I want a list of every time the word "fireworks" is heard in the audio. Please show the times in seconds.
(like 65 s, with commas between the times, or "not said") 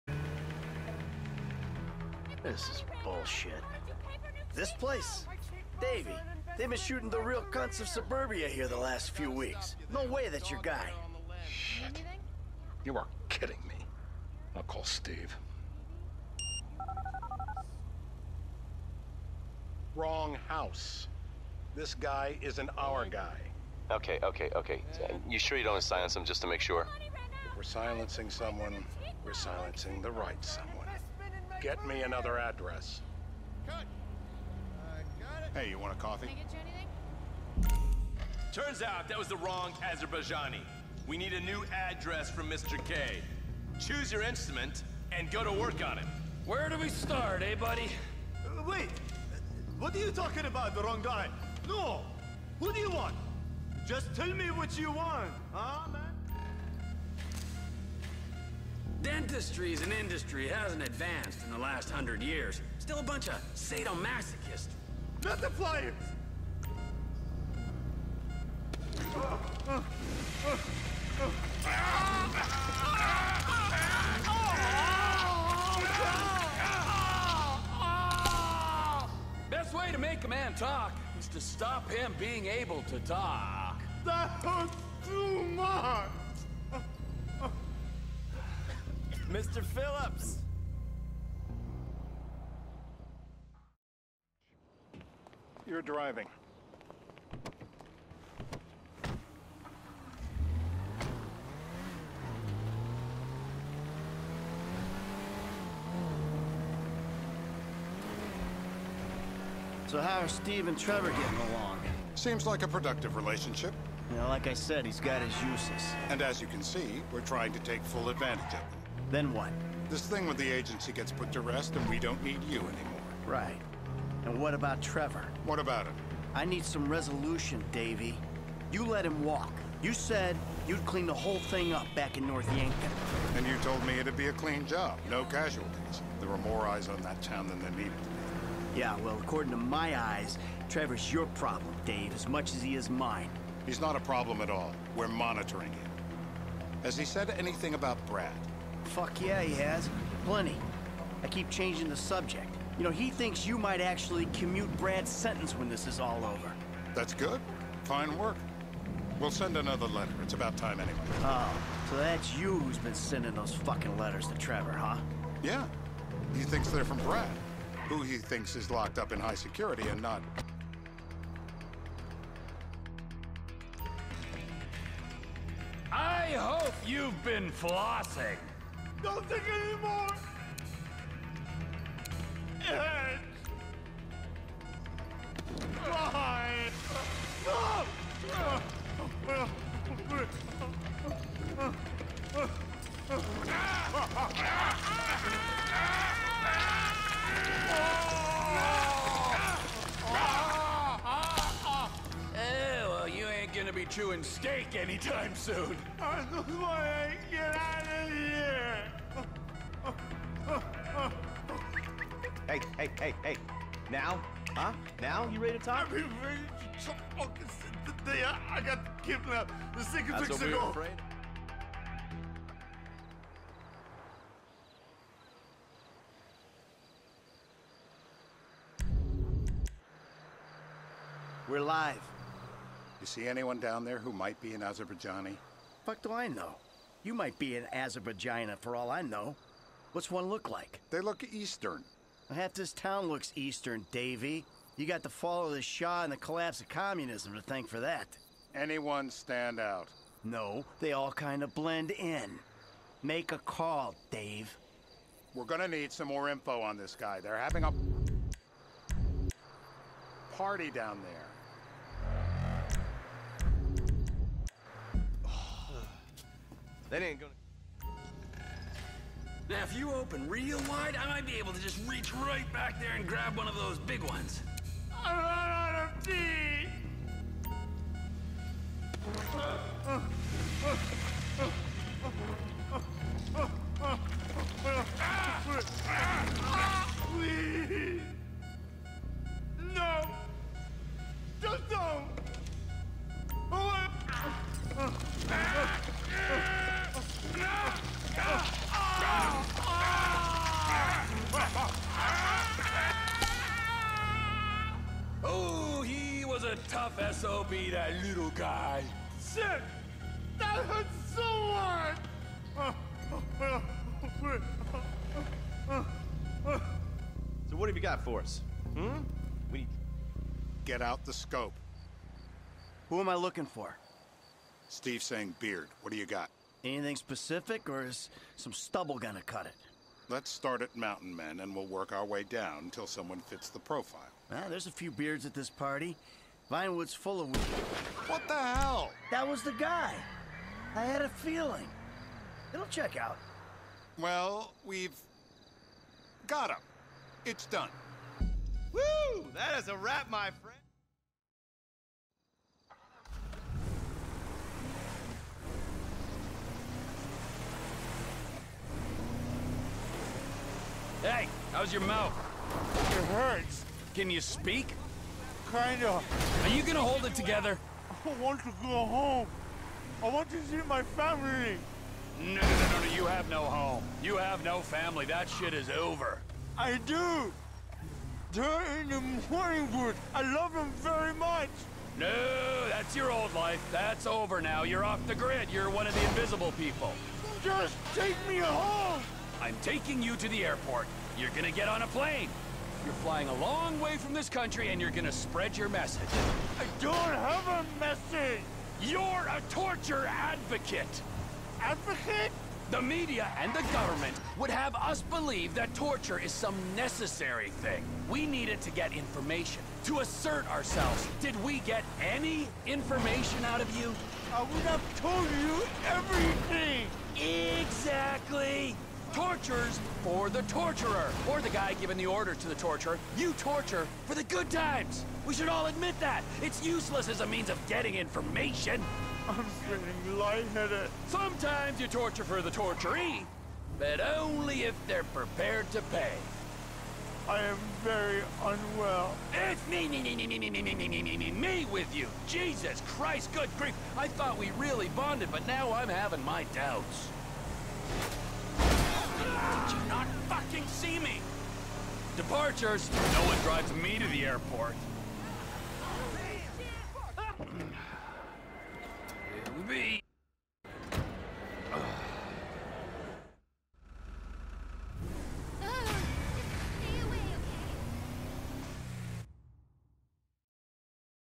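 not said.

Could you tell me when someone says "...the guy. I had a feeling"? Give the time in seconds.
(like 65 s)
339 s.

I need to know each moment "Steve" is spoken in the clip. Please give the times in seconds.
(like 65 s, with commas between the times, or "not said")
14 s, 110 s, 324 s.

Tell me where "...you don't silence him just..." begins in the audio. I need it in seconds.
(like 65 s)
25 s.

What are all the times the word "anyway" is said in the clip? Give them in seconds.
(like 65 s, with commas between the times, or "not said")
160 s.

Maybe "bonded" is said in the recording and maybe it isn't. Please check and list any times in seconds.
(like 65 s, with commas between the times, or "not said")
444 s.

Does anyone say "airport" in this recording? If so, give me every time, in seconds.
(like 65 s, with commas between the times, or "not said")
390 s, 454 s.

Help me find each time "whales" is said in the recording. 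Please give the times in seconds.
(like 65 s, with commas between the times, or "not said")
not said.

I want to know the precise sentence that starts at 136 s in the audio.
There were more eyes on that town than there needed to be.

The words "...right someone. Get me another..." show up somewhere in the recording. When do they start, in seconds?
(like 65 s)
30 s.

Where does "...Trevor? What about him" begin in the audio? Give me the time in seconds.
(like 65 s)
124 s.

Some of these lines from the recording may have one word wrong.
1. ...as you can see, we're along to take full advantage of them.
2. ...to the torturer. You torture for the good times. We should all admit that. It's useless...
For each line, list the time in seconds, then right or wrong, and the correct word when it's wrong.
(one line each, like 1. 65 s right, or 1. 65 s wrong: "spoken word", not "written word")
1. 116 s wrong: "trying", not "along"
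2. 422 s right.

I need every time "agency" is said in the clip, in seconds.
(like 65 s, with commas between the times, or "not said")
120 s.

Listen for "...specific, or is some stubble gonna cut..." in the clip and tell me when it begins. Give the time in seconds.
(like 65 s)
326 s.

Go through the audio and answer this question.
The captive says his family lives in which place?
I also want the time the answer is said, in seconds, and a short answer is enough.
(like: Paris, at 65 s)
Morningwood, at 378 s.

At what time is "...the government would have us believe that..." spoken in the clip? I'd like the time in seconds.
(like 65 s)
403 s.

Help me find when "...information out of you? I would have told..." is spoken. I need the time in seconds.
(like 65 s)
412 s.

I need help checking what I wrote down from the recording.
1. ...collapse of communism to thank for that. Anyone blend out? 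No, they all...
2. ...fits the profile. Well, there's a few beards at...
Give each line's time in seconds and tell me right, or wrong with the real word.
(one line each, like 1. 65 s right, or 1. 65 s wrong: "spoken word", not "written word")
1. 246 s wrong: "stand", not "blend"
2. 333 s right.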